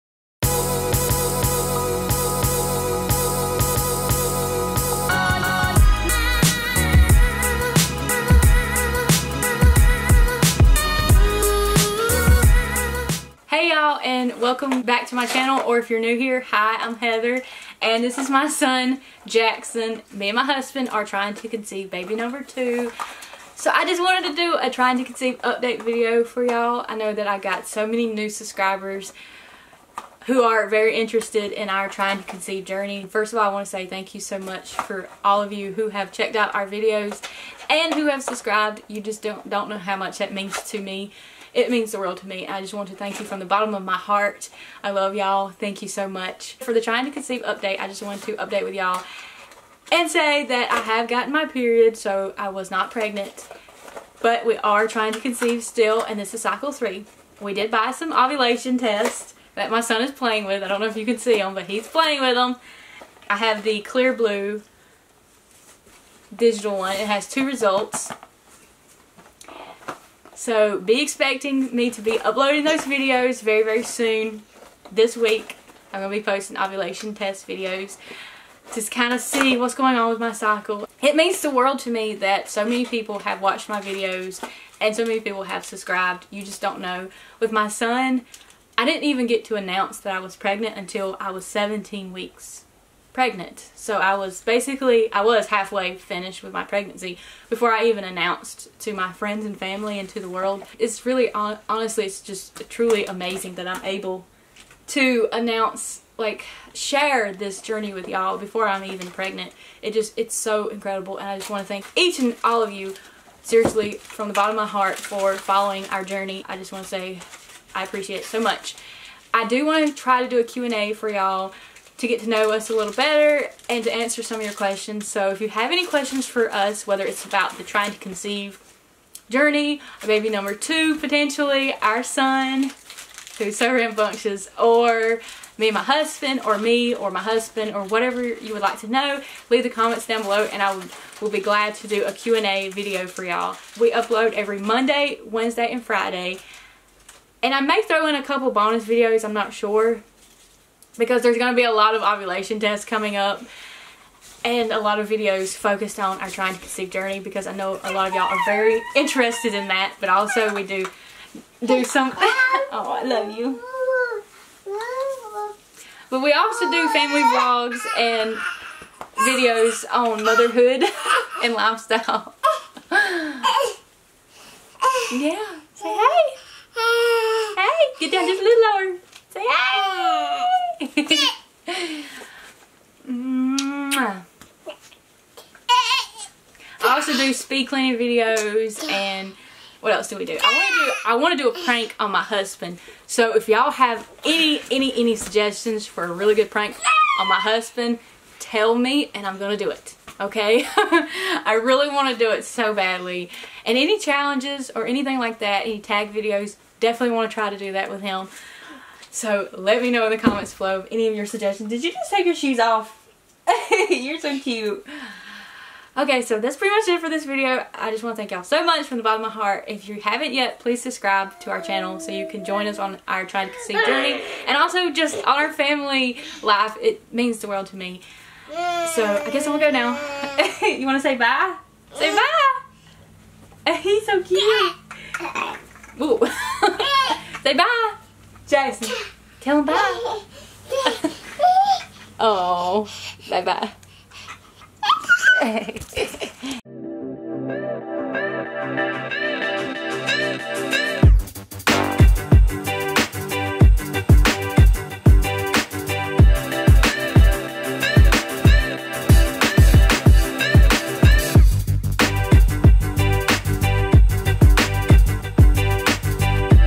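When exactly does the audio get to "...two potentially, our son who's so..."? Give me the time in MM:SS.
02:10.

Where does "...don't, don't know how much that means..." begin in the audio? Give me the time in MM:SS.
00:39.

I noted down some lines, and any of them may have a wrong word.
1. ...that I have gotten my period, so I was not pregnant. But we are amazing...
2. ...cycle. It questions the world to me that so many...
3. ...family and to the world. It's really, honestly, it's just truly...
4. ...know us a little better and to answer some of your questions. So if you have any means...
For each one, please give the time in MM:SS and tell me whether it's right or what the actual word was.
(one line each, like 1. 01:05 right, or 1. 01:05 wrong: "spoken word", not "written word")
1. 00:50 wrong: "trying", not "amazing"
2. 01:20 wrong: "means", not "questions"
3. 01:39 right
4. 02:02 wrong: "questions", not "means".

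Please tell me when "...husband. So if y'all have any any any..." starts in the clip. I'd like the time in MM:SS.
03:12.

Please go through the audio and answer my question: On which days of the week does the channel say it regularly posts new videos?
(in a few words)
Monday, Wednesday, and Friday.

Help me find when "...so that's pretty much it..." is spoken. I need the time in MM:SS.
03:36.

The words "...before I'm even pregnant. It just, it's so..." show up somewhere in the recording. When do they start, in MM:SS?
01:48.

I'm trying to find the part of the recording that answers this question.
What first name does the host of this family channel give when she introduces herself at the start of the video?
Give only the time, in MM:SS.
00:16.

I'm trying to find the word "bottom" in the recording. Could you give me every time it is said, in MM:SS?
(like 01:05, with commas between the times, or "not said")
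00:43, 01:54, 03:39.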